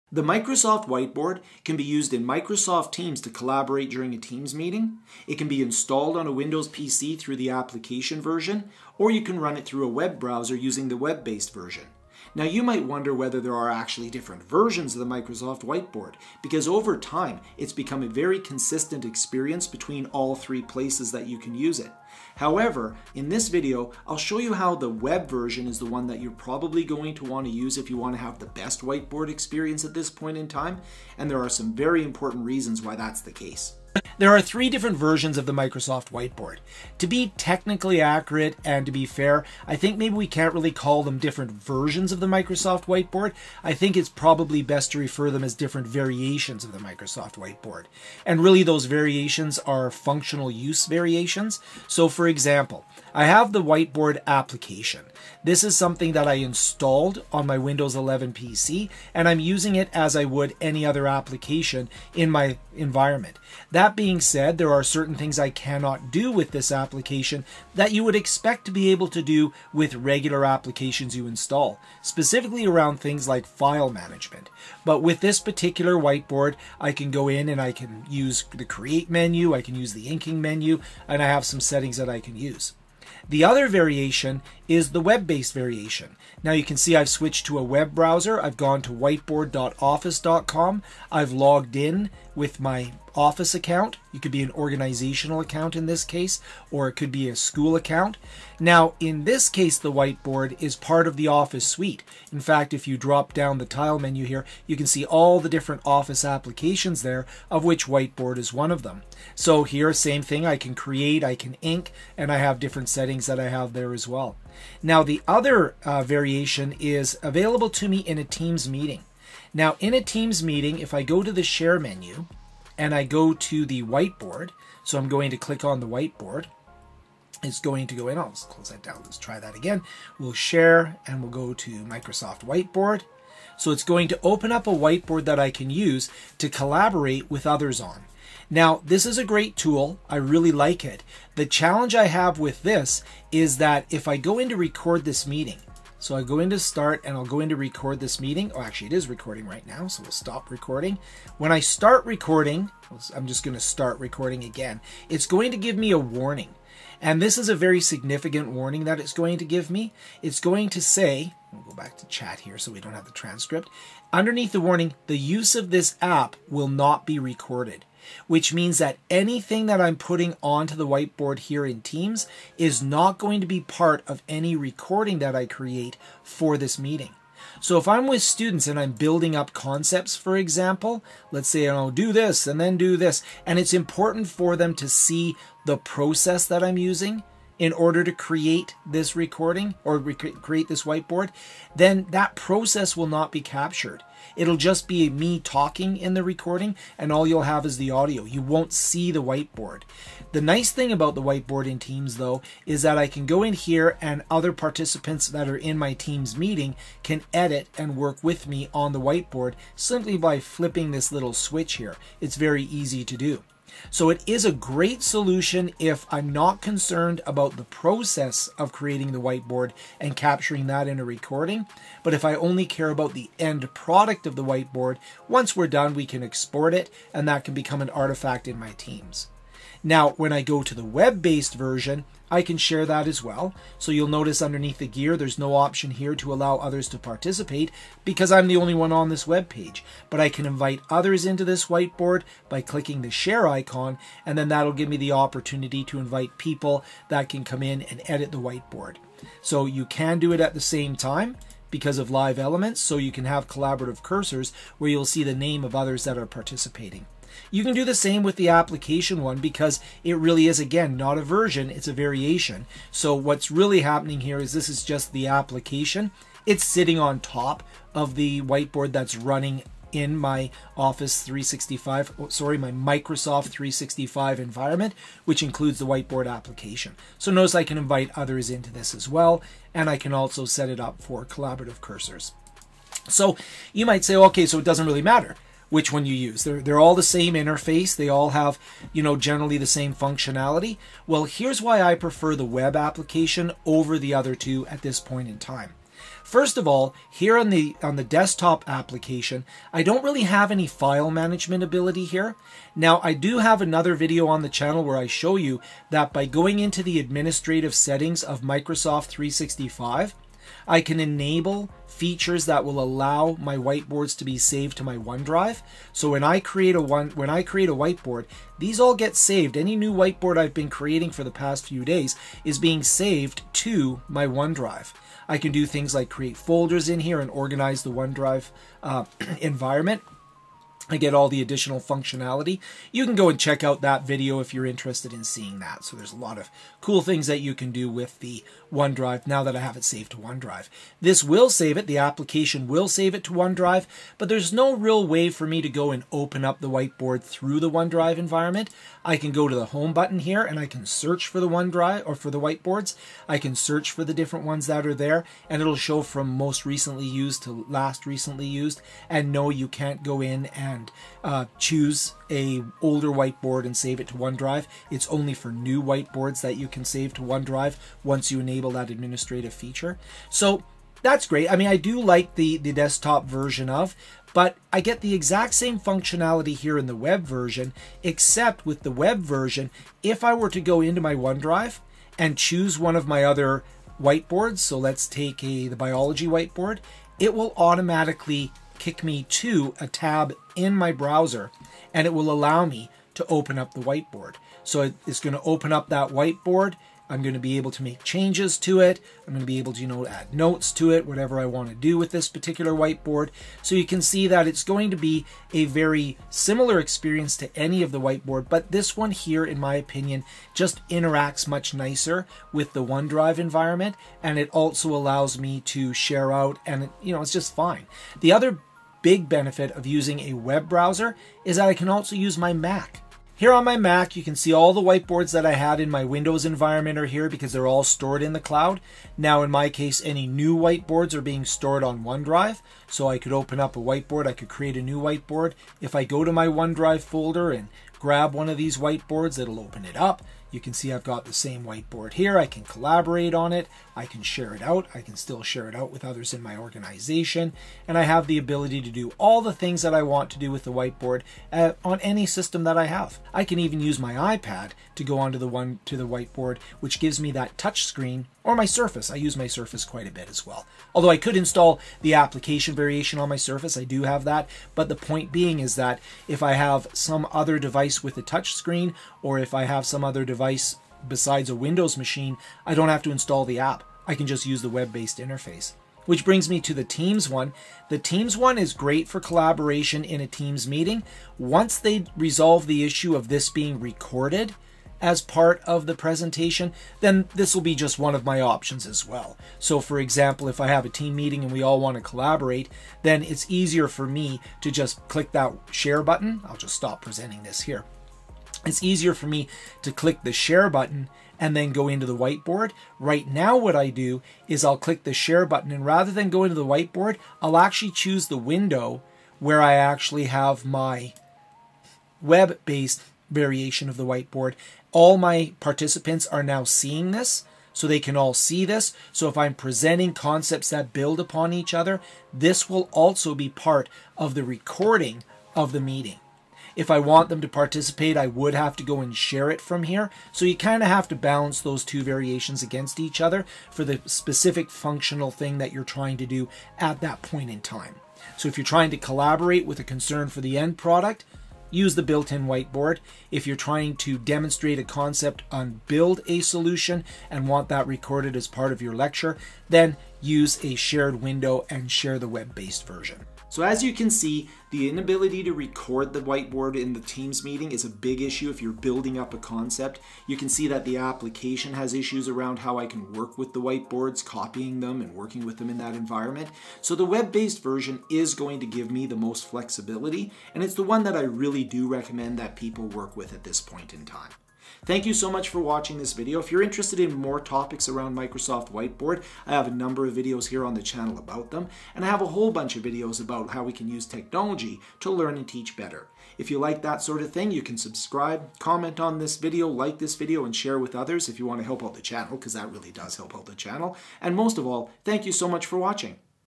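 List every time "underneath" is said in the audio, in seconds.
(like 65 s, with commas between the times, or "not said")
164 s, 234 s.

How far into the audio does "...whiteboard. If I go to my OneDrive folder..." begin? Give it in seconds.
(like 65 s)
435 s.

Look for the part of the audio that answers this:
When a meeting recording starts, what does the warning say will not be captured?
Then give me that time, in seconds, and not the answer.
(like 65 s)
165 s.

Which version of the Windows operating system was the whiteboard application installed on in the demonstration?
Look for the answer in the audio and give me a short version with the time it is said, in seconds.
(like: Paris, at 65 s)
Windows 11, at 57 s.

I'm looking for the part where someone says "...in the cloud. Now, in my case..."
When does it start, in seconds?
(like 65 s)
428 s.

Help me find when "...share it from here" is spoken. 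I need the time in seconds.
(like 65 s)
529 s.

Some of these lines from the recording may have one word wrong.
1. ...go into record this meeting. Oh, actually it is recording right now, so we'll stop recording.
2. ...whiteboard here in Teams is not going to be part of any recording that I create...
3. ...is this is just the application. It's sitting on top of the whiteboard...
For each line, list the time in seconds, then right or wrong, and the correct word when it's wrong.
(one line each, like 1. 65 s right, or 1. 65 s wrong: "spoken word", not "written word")
1. 147 s right
2. 170 s right
3. 264 s right.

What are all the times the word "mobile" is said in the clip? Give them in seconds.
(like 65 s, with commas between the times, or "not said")
not said.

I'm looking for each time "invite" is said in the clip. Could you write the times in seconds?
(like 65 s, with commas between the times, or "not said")
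240 s, 245 s, 277 s.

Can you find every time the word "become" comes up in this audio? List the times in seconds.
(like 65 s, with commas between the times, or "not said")
17 s, 227 s.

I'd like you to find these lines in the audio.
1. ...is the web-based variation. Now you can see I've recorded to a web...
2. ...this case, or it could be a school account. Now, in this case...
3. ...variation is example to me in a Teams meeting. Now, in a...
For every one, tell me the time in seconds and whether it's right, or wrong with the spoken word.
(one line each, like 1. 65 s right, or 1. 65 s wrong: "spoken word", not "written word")
1. 84 s wrong: "switched", not "recorded"
2. 95 s right
3. 116 s wrong: "available", not "example".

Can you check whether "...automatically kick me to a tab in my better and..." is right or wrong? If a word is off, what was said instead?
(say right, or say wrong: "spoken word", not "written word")
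wrong: "browser", not "better".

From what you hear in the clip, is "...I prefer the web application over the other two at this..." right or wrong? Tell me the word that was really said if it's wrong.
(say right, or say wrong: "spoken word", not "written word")
right.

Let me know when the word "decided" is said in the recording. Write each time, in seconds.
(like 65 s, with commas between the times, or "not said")
not said.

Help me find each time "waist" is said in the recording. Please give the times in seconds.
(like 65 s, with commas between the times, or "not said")
not said.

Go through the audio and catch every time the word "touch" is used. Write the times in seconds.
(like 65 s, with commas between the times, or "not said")
457 s, 468 s.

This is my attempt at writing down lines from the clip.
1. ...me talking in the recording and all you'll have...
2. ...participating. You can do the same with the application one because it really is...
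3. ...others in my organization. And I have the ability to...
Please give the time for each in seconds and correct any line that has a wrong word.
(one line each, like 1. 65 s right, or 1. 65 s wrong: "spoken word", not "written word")
1. 195 s right
2. 256 s right
3. 446 s right.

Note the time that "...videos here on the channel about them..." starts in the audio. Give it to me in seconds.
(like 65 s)
580 s.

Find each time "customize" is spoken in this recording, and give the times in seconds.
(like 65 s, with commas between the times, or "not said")
not said.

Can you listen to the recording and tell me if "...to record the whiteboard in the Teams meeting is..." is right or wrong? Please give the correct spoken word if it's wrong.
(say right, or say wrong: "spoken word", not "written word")
right.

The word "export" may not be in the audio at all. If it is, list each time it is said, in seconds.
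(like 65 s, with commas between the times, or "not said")
226 s.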